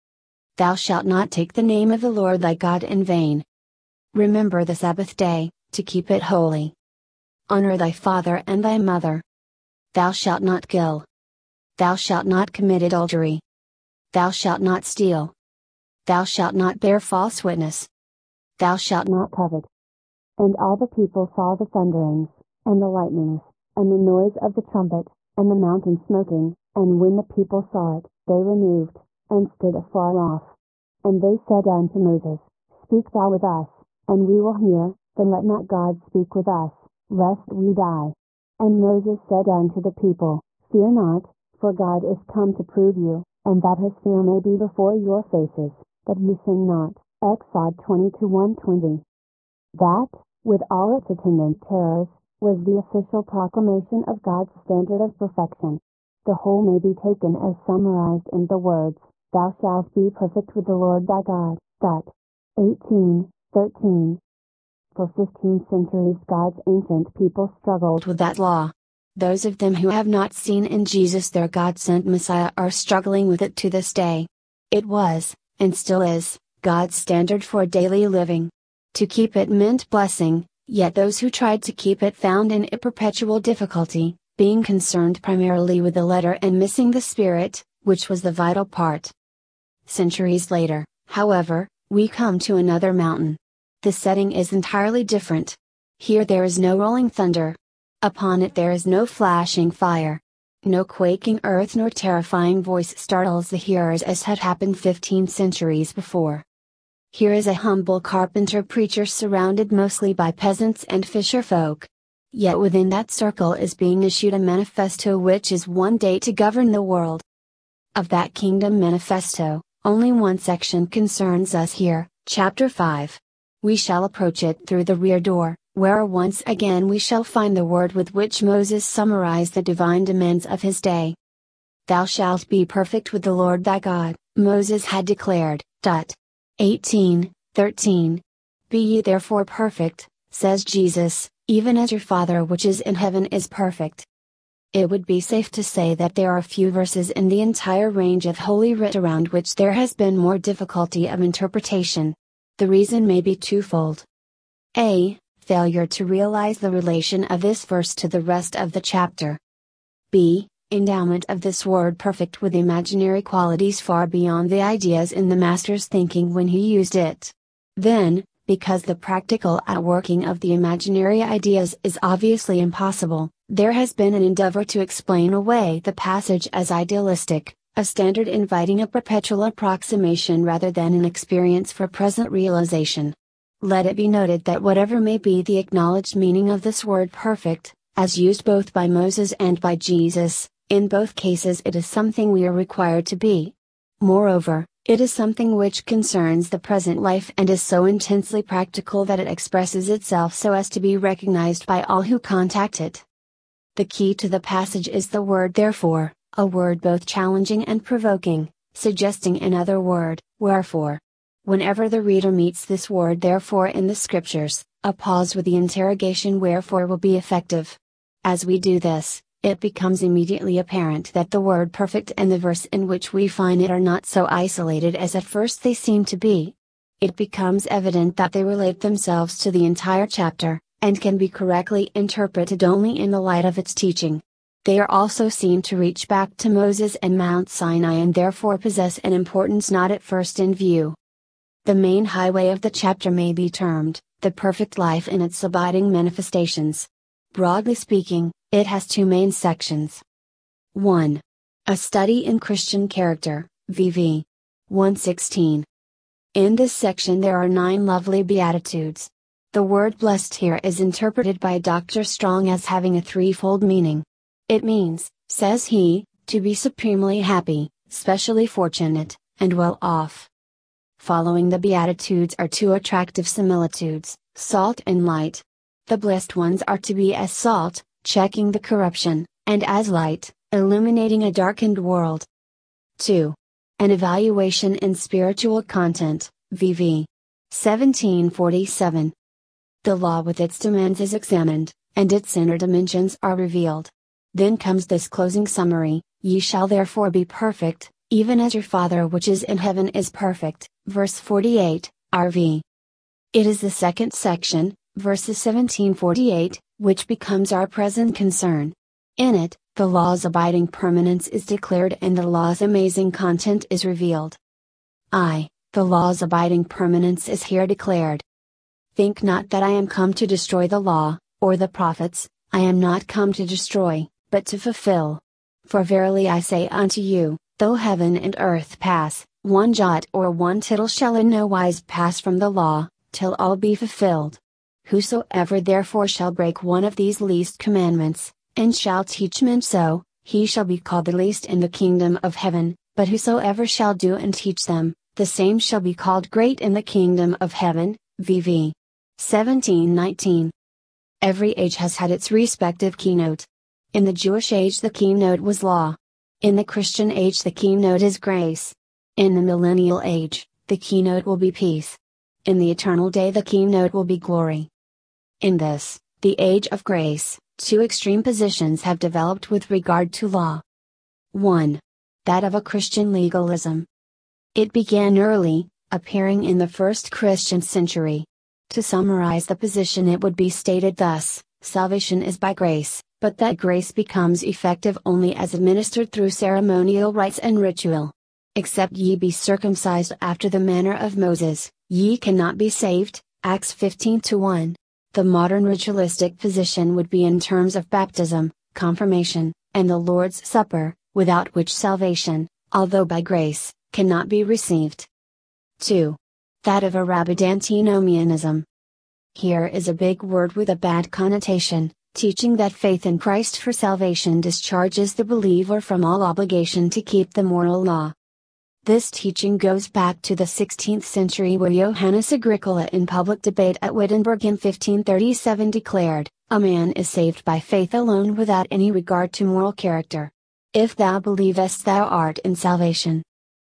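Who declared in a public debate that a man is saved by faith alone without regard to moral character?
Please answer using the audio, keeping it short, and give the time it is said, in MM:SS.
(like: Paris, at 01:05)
Johannes Agricola, at 07:01.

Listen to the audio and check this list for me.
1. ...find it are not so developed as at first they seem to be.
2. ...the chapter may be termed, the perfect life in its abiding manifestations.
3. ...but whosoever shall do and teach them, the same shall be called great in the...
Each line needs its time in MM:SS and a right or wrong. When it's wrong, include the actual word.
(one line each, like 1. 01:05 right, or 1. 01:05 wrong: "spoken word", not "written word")
1. 03:43 wrong: "isolated", not "developed"
2. 04:02 right
3. 05:42 right.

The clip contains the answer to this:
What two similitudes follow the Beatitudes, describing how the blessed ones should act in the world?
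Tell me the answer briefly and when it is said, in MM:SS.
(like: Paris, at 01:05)
Salt and light, at 04:34.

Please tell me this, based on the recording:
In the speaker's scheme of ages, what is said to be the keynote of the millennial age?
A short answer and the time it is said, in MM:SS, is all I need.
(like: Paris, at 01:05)
Peace, at 06:01.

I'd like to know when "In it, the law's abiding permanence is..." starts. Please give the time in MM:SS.
05:09.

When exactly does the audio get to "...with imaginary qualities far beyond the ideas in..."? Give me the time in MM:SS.
02:42.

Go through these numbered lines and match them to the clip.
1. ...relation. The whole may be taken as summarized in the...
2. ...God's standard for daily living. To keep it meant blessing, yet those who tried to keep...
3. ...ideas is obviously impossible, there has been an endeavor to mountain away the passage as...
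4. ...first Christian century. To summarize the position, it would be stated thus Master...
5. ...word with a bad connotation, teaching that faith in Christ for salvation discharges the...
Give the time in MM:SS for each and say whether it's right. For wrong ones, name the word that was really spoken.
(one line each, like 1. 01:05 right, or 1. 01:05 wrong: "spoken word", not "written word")
1. 00:55 wrong: "perfection", not "relation"
2. 01:16 right
3. 02:51 wrong: "explain", not "mountain"
4. 06:16 wrong: "Salvation", not "Master"
5. 06:50 right.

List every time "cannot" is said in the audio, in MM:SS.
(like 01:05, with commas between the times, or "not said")
06:32, 06:43.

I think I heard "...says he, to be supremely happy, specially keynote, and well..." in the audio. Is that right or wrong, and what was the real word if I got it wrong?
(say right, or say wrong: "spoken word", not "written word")
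wrong: "fortunate", not "keynote".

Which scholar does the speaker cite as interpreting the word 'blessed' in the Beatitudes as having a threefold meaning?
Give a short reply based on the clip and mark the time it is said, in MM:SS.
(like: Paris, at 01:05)
Dr. Strong, at 04:21.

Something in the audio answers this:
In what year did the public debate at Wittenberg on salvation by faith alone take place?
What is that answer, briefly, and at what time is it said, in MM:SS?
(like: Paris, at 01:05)
1537, at 07:04.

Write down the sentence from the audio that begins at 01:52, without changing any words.
Yet within that circle is being issued a manifesto which is one day to govern the world.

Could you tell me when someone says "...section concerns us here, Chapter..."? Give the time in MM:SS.
02:00.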